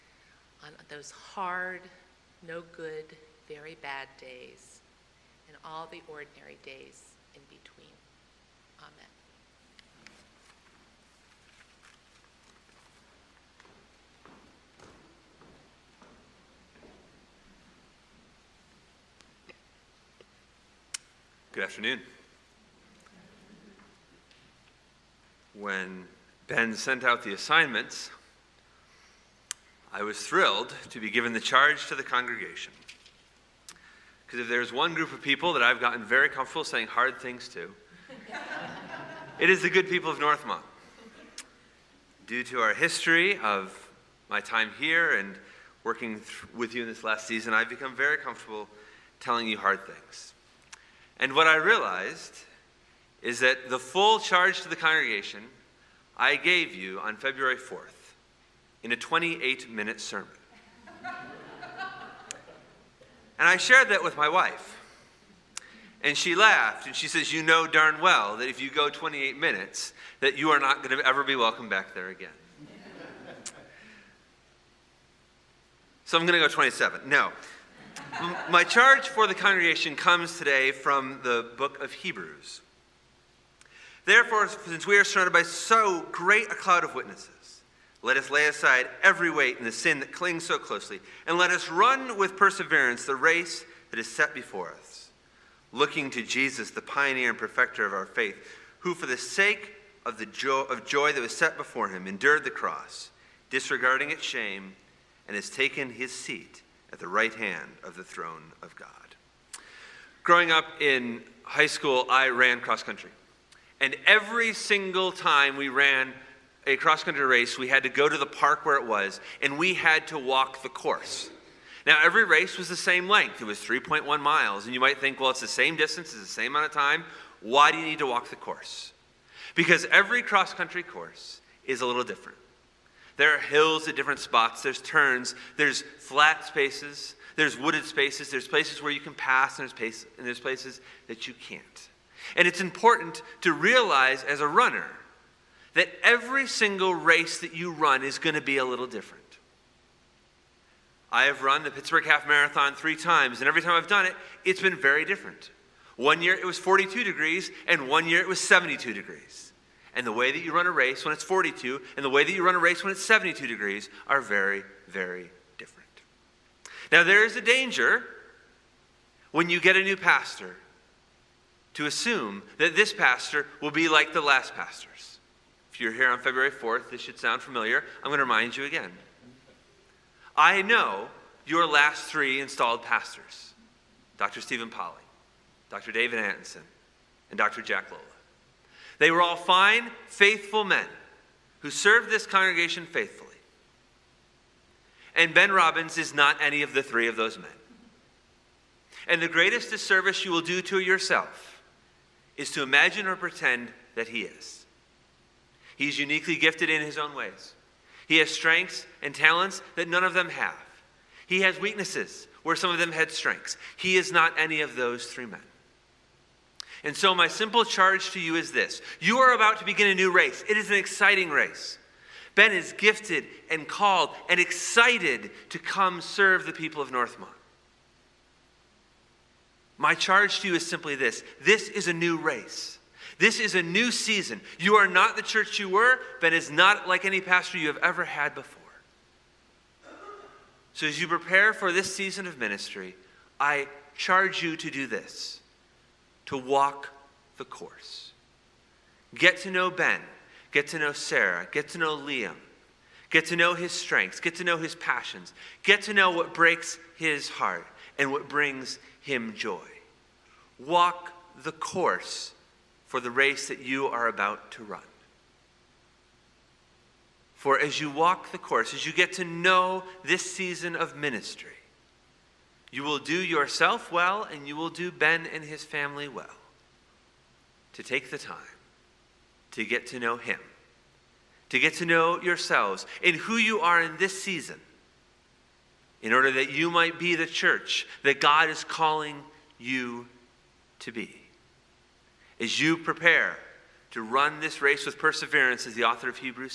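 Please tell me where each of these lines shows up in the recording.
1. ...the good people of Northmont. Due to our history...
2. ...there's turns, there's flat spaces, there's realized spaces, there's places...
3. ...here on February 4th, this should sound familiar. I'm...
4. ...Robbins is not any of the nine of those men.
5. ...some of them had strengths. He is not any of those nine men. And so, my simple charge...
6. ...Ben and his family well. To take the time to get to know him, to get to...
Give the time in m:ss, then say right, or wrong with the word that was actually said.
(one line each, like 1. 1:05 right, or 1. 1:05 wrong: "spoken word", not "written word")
1. 0:39 right
2. 2:14 wrong: "wooded", not "realized"
3. 2:55 right
4. 3:15 wrong: "three", not "nine"
5. 3:32 wrong: "three", not "nine"
6. 4:34 right.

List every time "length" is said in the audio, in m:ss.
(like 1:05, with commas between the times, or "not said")
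2:03.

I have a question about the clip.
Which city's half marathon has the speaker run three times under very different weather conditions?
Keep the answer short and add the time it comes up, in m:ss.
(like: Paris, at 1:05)
Pittsburgh, at 2:31.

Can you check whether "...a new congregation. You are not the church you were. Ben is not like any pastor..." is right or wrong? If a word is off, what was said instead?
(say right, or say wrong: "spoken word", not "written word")
wrong: "season", not "congregation".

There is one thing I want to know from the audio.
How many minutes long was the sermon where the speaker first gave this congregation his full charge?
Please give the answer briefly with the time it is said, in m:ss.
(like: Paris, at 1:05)
28, at 0:58.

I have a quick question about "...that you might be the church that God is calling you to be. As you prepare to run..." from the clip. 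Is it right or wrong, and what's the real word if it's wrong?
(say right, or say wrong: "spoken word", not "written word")
right.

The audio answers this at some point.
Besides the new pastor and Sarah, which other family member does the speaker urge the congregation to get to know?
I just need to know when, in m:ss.
4:11.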